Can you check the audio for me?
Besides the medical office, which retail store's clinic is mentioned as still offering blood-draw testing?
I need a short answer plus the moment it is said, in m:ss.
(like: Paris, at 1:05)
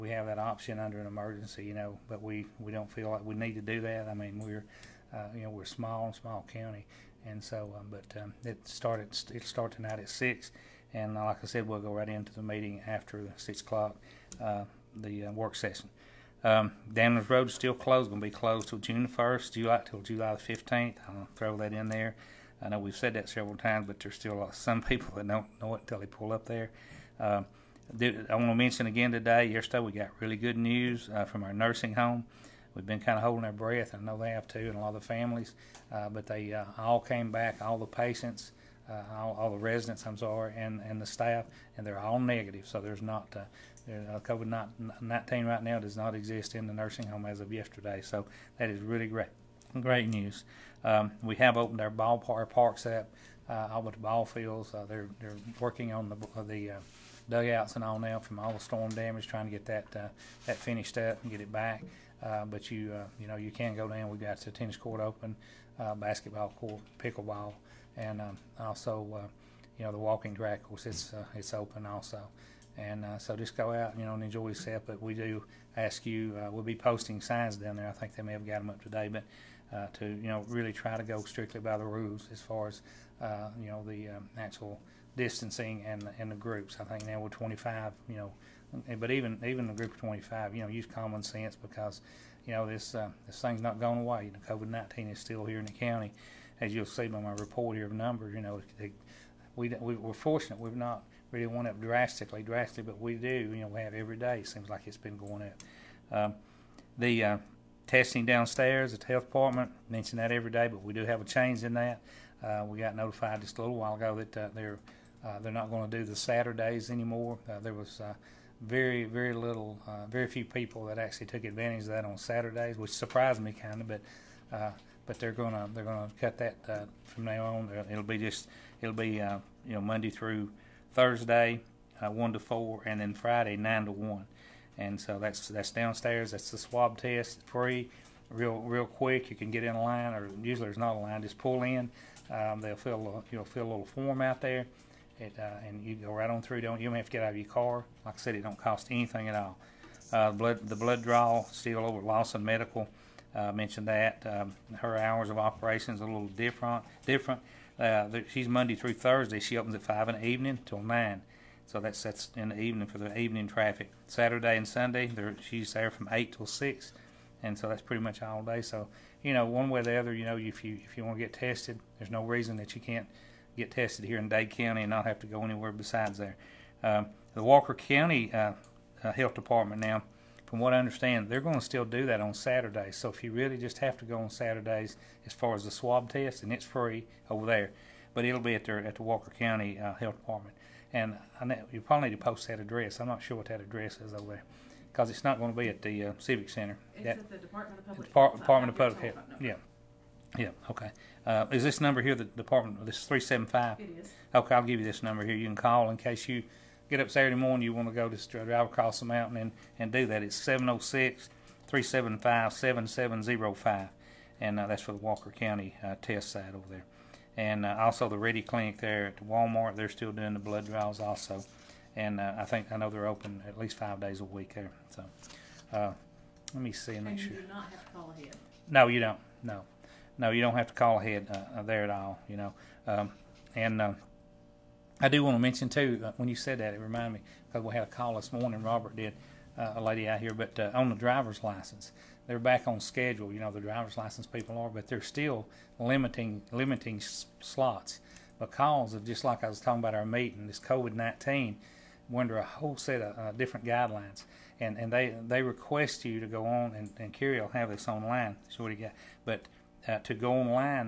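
Walmart, at 3:39.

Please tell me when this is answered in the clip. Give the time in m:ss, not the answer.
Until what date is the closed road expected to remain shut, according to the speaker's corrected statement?
0:19.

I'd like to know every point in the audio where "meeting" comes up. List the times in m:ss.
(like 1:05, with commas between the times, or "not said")
0:12, 4:10.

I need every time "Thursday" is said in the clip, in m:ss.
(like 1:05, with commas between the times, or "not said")
2:10, 2:38.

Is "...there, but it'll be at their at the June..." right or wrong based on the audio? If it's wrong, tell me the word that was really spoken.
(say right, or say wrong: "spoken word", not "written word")
wrong: "Walker", not "June".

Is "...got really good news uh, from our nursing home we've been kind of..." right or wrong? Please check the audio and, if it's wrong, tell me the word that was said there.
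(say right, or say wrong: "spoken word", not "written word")
right.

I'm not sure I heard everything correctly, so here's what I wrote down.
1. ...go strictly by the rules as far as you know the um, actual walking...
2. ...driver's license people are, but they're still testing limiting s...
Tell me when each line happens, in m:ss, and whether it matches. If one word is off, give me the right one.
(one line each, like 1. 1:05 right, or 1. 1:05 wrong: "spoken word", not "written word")
1. 1:21 wrong: "distancing", not "walking"
2. 4:03 wrong: "limiting", not "testing".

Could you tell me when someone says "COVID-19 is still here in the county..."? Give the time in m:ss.
1:34.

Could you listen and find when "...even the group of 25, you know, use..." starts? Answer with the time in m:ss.
1:29.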